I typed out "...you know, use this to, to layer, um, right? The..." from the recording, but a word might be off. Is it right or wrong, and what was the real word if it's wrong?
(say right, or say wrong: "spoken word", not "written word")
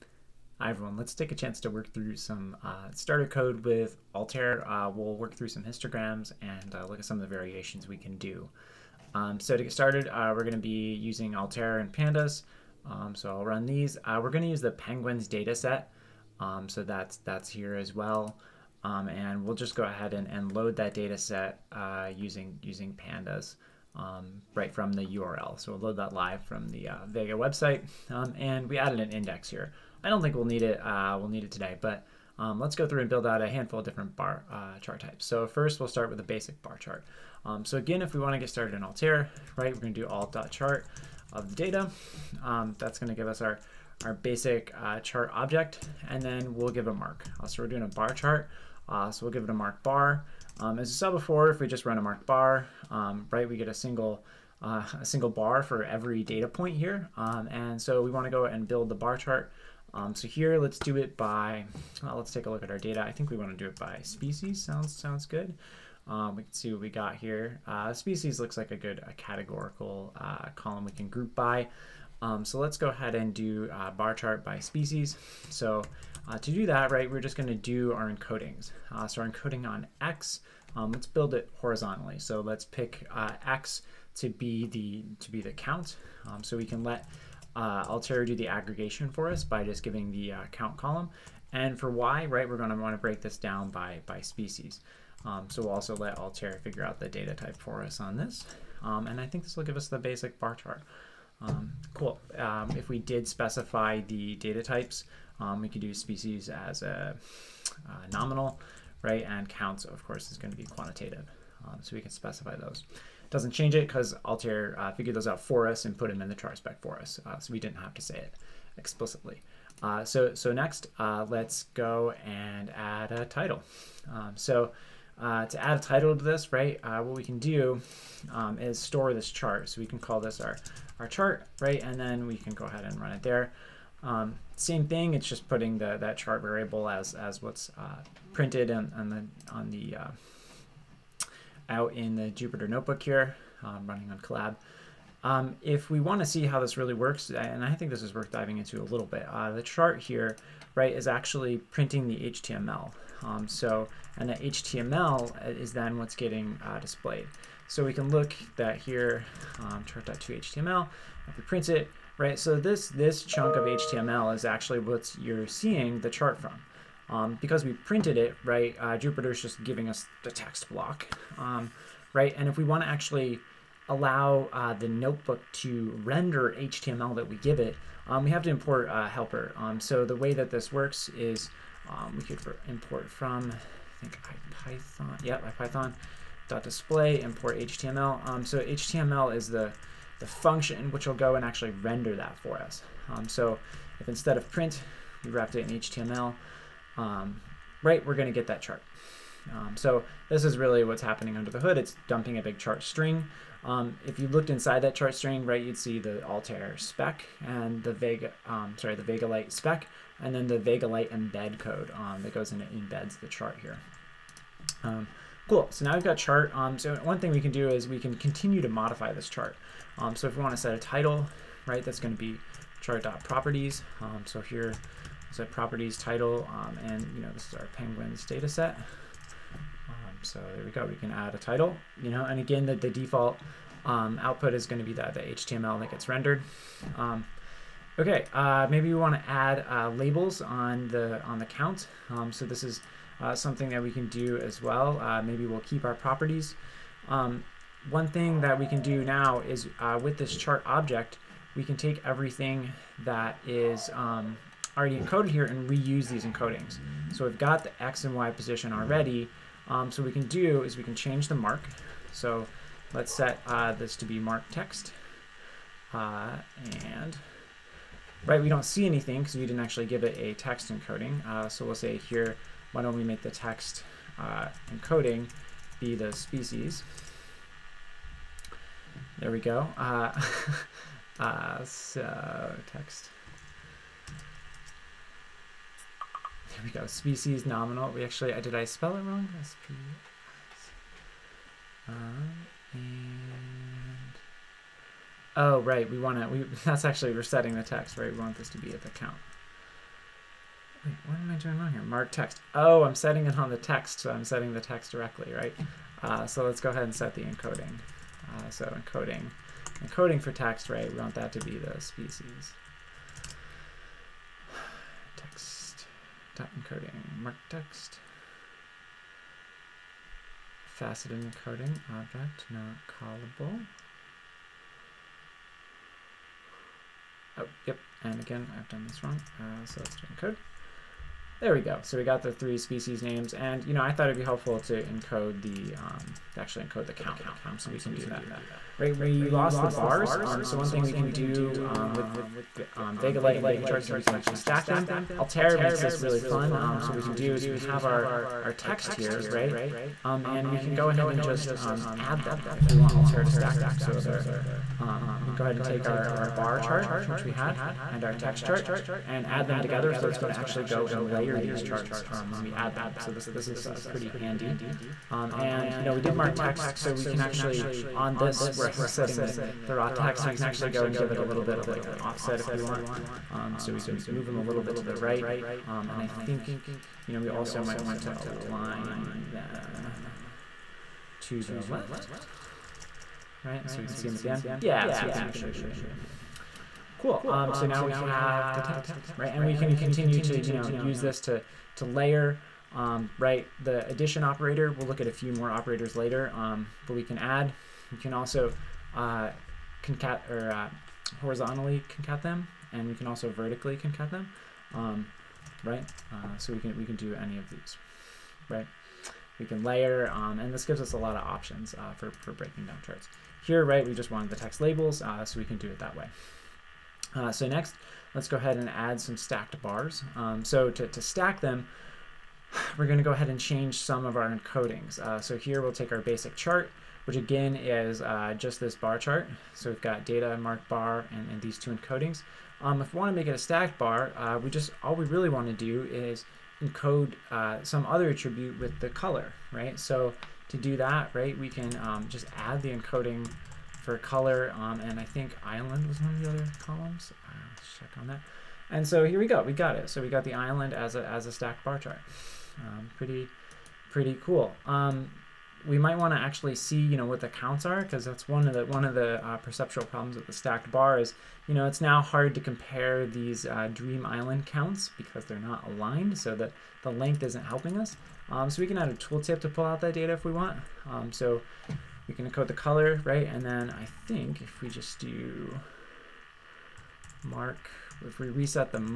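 right.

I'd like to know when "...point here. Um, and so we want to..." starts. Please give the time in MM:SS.
00:56.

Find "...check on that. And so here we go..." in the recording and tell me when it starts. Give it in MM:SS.
07:27.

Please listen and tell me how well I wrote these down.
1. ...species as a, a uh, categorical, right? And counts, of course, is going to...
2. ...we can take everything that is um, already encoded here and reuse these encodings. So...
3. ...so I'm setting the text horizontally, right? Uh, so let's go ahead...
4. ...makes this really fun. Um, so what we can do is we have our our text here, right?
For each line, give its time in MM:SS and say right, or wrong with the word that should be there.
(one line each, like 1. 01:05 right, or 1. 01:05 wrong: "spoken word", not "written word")
1. 01:45 wrong: "nominal", not "categorical"
2. 04:11 right
3. 05:03 wrong: "directly", not "horizontally"
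4. 05:45 right.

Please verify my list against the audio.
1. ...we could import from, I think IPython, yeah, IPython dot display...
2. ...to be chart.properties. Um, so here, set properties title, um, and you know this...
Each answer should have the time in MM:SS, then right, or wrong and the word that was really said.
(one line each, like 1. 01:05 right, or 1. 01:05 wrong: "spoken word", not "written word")
1. 03:02 right
2. 03:42 right.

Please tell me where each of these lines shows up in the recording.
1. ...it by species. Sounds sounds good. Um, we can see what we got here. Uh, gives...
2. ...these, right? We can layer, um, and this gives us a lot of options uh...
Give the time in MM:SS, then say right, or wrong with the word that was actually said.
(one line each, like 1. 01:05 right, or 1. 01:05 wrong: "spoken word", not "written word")
1. 01:03 wrong: "species", not "gives"
2. 06:47 right.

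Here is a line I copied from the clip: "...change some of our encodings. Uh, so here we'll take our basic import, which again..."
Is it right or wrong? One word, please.
wrong.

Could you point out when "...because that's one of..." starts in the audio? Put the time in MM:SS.
07:37.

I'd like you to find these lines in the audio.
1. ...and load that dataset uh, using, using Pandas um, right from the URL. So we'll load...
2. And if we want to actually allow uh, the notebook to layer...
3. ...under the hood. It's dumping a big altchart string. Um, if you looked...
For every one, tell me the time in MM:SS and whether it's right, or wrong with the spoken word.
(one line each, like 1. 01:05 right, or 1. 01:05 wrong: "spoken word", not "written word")
1. 00:20 right
2. 02:52 wrong: "render", not "layer"
3. 03:21 wrong: "chart", not "altchart".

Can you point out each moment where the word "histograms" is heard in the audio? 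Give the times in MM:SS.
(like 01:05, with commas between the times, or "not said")
00:05.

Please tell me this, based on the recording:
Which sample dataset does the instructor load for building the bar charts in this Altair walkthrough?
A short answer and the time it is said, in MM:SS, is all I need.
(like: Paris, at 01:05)
Penguins dataset, at 00:14.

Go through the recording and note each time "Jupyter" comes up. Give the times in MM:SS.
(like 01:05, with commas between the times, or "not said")
02:22, 02:48.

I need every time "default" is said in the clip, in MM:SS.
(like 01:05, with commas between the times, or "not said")
03:52.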